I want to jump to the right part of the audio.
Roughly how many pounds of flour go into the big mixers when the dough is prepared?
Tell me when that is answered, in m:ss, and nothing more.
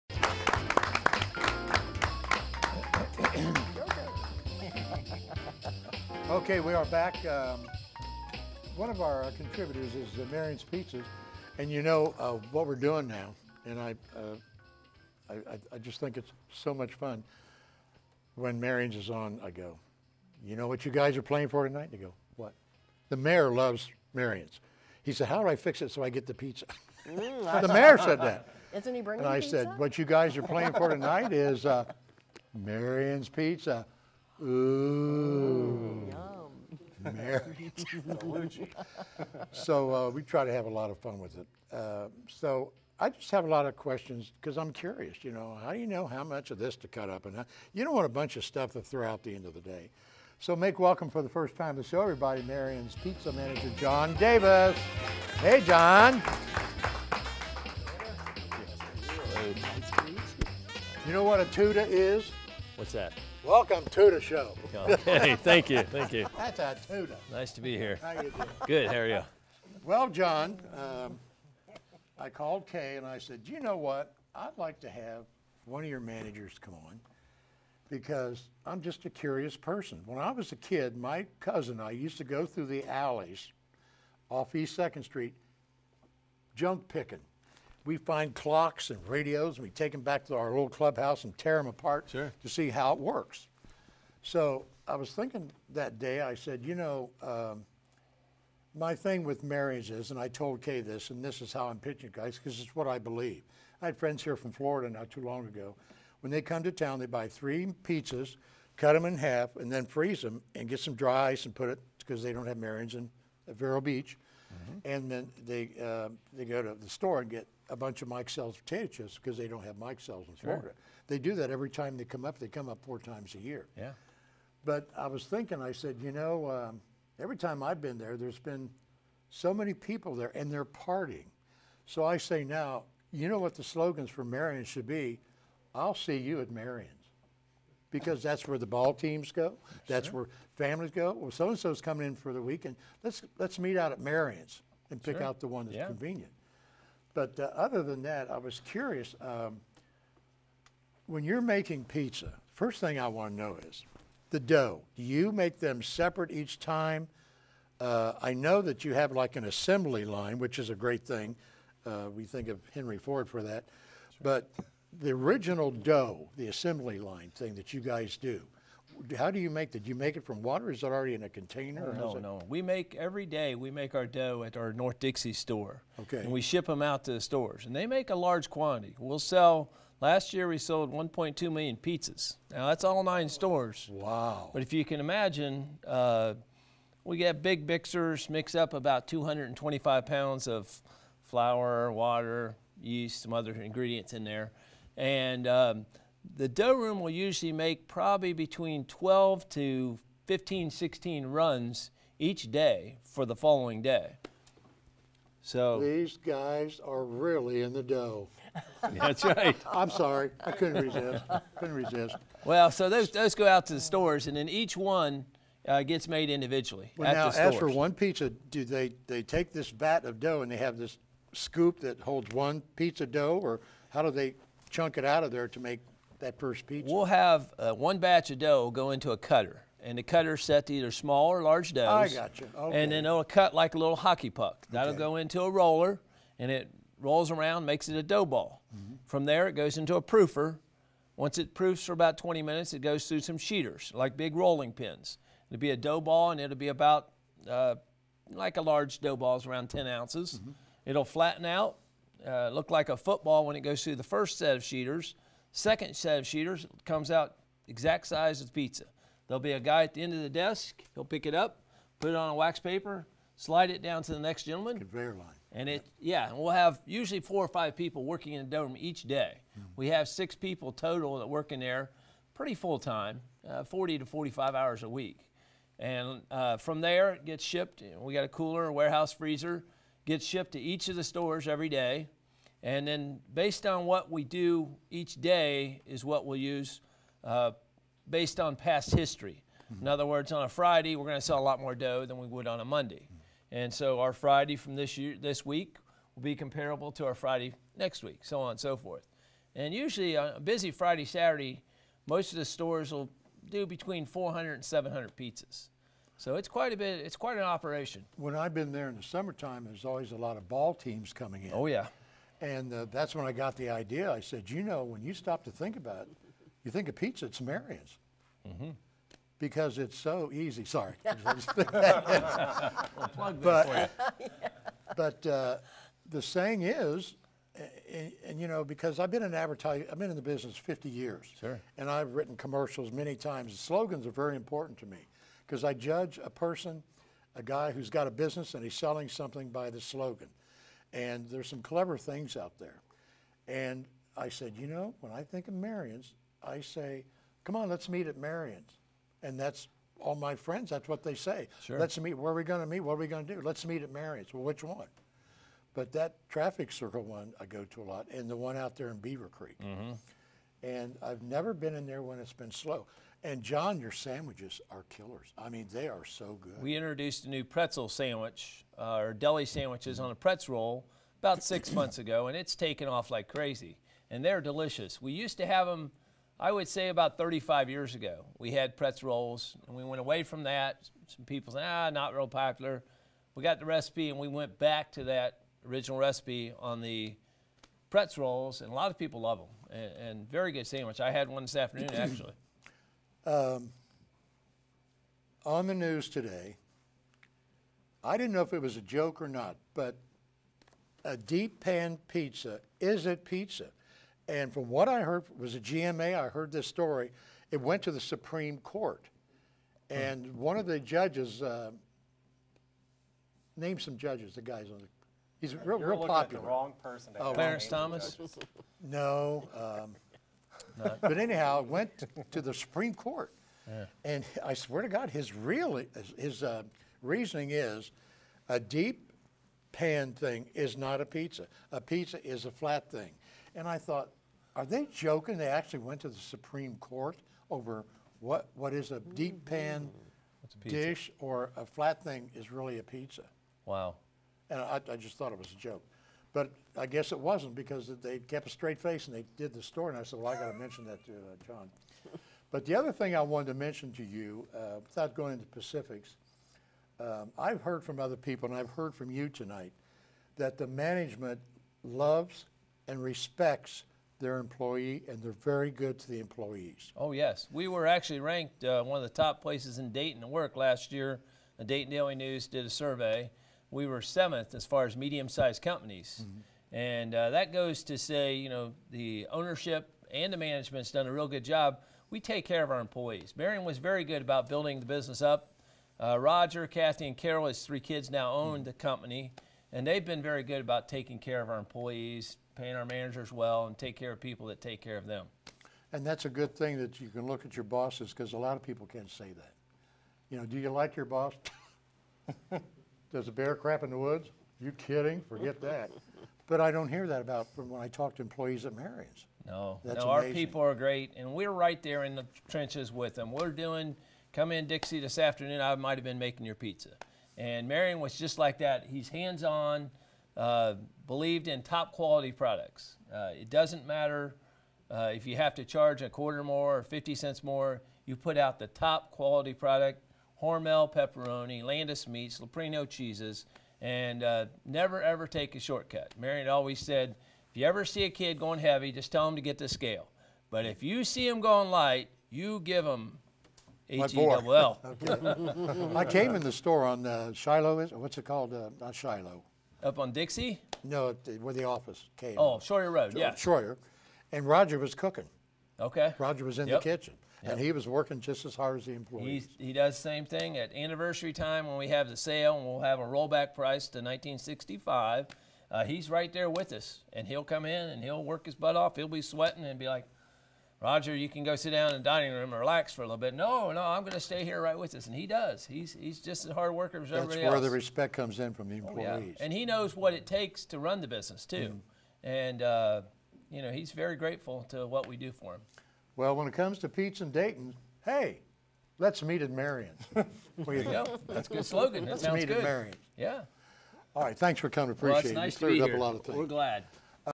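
3:09.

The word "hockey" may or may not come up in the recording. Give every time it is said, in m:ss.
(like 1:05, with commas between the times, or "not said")
3:53.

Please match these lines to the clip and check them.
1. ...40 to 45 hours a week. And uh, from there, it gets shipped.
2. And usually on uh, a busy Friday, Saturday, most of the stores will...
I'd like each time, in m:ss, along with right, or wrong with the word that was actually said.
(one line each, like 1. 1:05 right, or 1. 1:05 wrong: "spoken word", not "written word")
1. 4:33 right
2. 4:59 right.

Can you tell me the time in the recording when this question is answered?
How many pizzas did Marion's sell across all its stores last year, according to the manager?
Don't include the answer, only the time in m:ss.
3:00.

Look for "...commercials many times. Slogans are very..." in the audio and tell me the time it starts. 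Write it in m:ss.
5:32.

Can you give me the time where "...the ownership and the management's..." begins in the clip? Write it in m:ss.
7:58.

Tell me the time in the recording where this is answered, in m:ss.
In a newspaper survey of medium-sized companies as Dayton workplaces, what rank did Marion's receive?
7:54.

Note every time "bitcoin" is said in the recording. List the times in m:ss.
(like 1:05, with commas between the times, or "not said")
not said.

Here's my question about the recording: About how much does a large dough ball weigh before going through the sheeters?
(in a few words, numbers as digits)
10 ounces.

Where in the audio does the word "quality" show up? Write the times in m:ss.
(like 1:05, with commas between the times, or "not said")
8:41, 8:49.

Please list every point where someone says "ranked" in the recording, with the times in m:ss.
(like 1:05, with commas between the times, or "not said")
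7:48.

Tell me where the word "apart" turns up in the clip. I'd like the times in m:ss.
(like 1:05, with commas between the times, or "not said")
1:31.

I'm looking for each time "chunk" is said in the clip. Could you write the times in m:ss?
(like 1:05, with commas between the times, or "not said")
3:44.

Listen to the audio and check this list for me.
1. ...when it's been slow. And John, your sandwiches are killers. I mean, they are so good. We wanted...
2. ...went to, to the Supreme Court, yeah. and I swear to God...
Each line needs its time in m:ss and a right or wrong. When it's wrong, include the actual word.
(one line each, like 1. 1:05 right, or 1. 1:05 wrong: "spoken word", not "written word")
1. 6:02 wrong: "introduced", not "wanted"
2. 7:01 right.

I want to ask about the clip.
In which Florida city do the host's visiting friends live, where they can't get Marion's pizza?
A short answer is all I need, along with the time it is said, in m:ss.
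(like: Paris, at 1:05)
Vero Beach, at 1:53.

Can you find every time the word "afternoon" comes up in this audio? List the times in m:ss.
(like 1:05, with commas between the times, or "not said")
6:31, 8:35.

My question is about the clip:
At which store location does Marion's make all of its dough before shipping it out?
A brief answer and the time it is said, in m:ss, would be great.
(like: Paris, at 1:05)
North Dixie, at 2:54.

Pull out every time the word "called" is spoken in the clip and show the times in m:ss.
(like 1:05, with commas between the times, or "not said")
1:12, 9:08.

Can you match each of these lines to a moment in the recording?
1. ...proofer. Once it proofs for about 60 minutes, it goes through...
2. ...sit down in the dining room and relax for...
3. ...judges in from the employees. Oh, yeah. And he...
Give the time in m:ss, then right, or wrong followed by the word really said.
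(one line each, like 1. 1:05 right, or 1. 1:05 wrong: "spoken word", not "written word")
1. 4:00 wrong: "20", not "60"
2. 9:31 right
3. 9:38 wrong: "comes", not "judges".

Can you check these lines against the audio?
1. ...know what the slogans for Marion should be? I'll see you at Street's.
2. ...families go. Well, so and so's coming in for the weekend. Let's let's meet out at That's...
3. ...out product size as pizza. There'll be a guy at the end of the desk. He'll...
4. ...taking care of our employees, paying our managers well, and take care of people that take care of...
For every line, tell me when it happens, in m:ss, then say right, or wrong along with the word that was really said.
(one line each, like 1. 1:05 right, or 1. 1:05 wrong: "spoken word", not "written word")
1. 2:13 wrong: "Marion", not "Street"
2. 2:20 wrong: "Marion", not "That"
3. 4:17 wrong: "exact", not "product"
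4. 8:10 right.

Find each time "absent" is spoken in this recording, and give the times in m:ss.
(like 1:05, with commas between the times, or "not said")
not said.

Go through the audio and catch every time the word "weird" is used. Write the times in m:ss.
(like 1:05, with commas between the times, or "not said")
not said.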